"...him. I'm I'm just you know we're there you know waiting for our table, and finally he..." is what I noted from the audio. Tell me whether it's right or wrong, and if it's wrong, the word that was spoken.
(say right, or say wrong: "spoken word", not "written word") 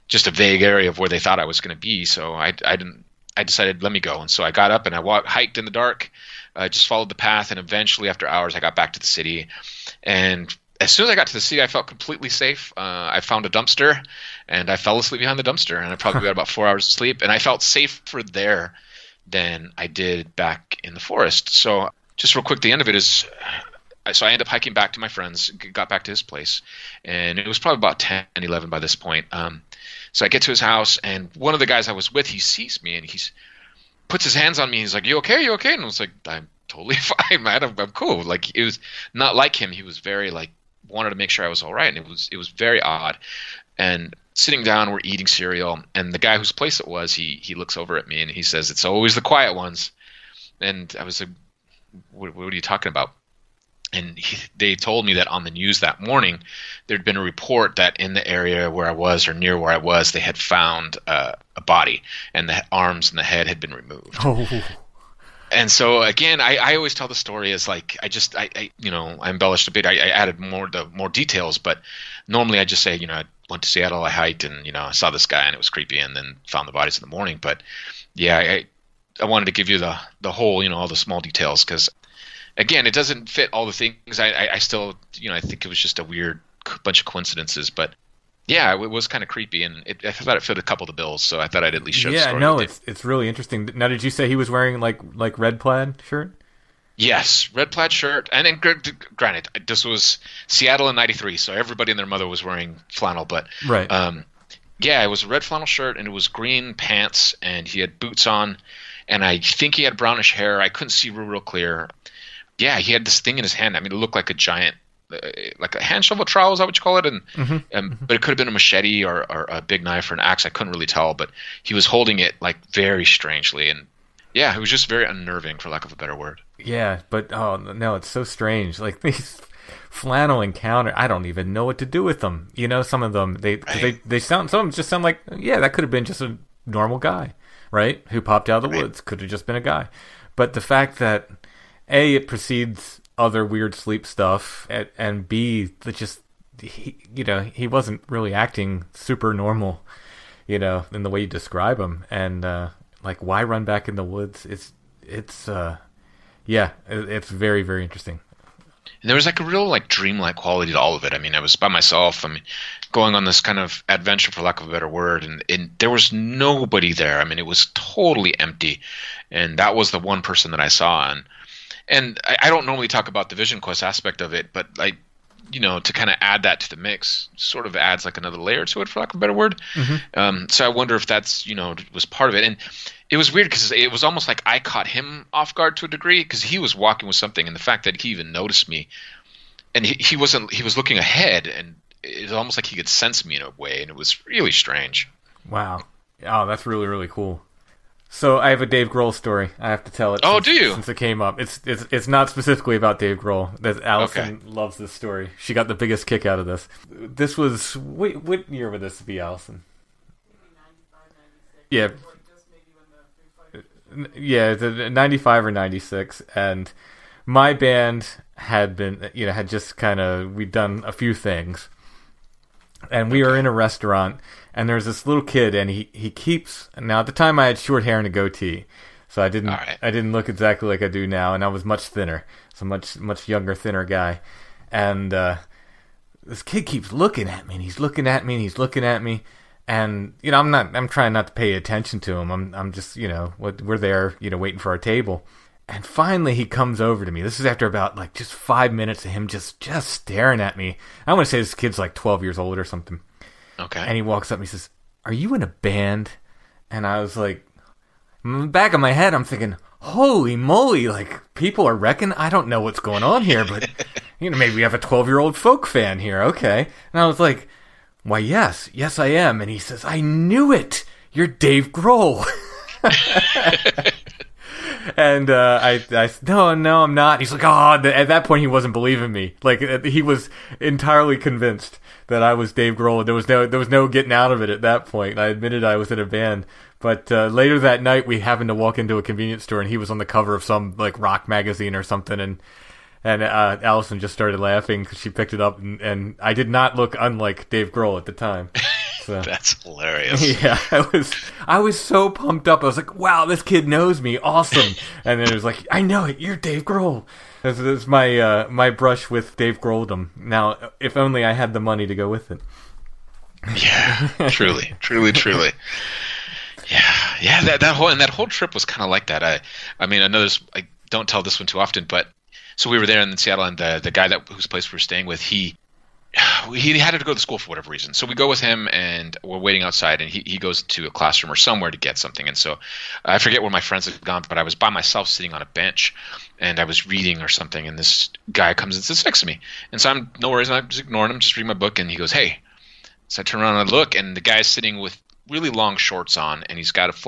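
right.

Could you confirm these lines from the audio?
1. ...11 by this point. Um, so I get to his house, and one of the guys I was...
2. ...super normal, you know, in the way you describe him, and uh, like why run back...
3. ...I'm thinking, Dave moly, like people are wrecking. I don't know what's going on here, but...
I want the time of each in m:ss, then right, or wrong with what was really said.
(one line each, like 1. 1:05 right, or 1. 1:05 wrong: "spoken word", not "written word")
1. 0:28 right
2. 2:28 right
3. 4:19 wrong: "Holy", not "Dave".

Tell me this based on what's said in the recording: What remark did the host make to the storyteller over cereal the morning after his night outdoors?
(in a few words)
It's always the quiet ones.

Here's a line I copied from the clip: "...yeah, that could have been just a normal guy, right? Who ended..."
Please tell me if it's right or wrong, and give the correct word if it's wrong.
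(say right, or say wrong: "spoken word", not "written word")
wrong: "popped", not "ended".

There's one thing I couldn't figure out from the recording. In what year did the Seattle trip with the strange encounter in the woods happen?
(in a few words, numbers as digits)
1993.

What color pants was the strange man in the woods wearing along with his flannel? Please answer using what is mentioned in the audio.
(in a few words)
Green.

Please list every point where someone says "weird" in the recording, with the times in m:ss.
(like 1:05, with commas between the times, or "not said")
1:26, 2:23, 3:03.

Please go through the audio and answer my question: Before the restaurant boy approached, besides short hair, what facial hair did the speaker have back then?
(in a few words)
A goatee.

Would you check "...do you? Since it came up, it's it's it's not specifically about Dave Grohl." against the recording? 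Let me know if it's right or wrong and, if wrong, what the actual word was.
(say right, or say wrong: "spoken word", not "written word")
right.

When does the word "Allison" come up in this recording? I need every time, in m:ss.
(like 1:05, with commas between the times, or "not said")
3:23, 3:29, 4:53.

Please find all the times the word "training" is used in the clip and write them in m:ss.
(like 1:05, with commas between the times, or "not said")
not said.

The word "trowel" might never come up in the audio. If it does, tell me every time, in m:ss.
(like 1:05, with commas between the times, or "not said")
1:56.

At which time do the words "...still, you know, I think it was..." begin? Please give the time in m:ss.
1:24.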